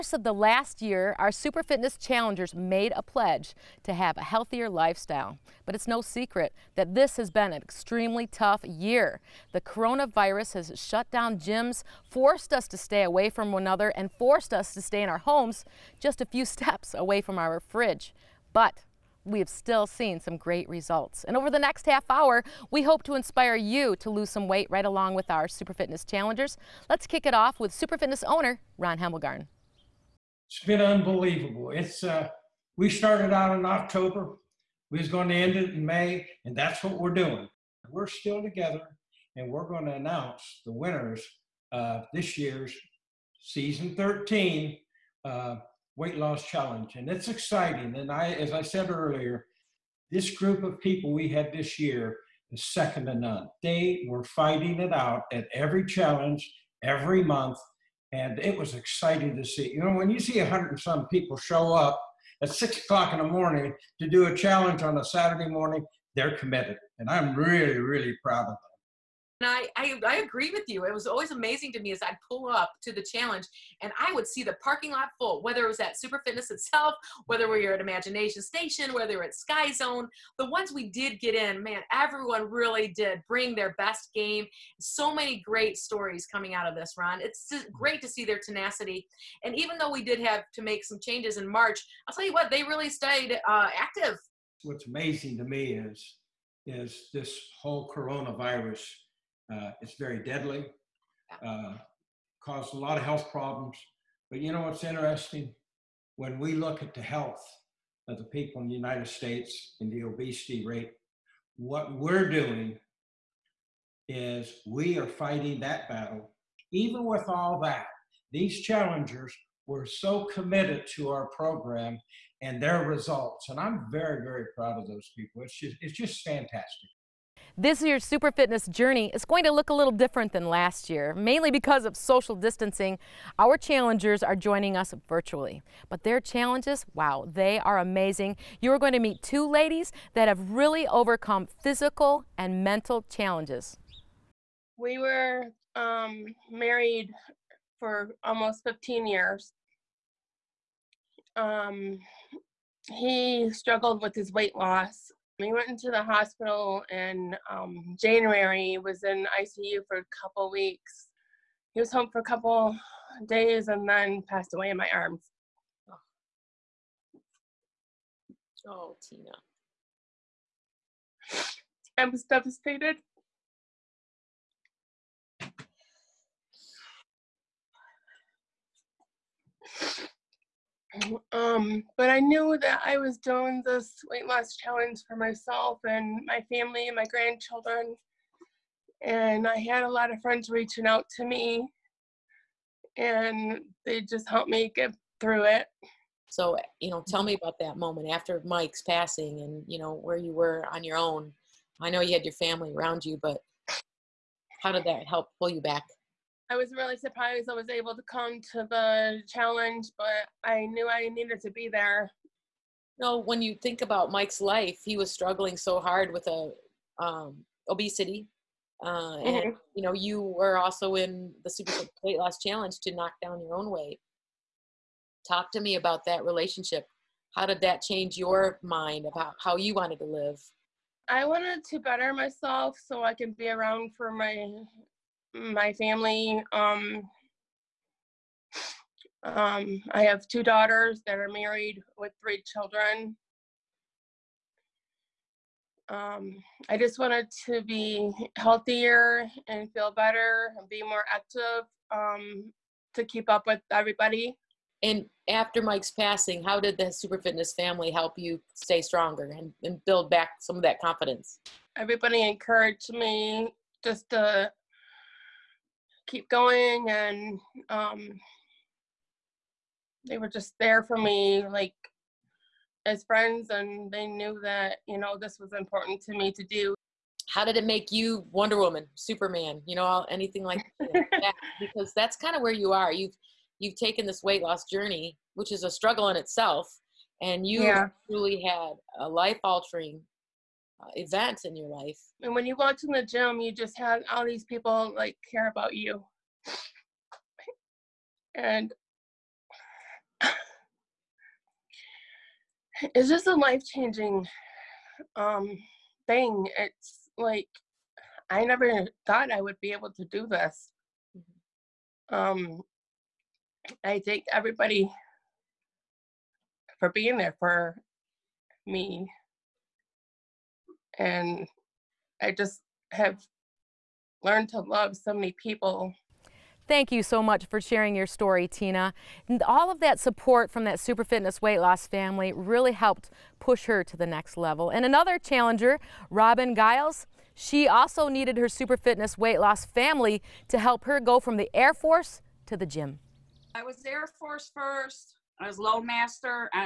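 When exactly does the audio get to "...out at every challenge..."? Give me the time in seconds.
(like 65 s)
54 s.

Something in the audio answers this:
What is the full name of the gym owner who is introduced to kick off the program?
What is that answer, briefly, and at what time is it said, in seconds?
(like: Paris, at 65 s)
Ron Hemmelgarn, at 28 s.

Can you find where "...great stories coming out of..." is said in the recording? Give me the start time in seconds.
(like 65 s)
85 s.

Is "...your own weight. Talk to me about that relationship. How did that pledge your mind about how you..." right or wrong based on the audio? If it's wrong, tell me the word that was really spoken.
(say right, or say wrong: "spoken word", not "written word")
wrong: "change", not "pledge".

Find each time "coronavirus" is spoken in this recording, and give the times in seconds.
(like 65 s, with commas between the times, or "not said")
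9 s, 97 s.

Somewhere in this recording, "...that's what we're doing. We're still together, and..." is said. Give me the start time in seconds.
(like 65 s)
36 s.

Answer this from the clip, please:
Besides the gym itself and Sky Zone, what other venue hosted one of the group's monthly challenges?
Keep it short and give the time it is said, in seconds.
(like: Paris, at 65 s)
Imagination Station, at 77 s.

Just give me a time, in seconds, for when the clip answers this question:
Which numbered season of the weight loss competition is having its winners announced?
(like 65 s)
43 s.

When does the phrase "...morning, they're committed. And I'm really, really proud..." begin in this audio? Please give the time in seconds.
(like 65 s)
65 s.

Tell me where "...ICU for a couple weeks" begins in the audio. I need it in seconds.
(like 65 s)
159 s.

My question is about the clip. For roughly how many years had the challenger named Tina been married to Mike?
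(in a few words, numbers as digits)
15.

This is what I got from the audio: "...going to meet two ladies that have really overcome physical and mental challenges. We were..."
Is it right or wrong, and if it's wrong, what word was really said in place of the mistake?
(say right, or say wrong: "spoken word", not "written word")
right.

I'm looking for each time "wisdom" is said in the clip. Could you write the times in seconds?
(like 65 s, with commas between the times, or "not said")
not said.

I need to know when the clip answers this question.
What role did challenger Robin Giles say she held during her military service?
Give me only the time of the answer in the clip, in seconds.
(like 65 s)
345 s.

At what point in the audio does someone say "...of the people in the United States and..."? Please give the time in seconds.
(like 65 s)
108 s.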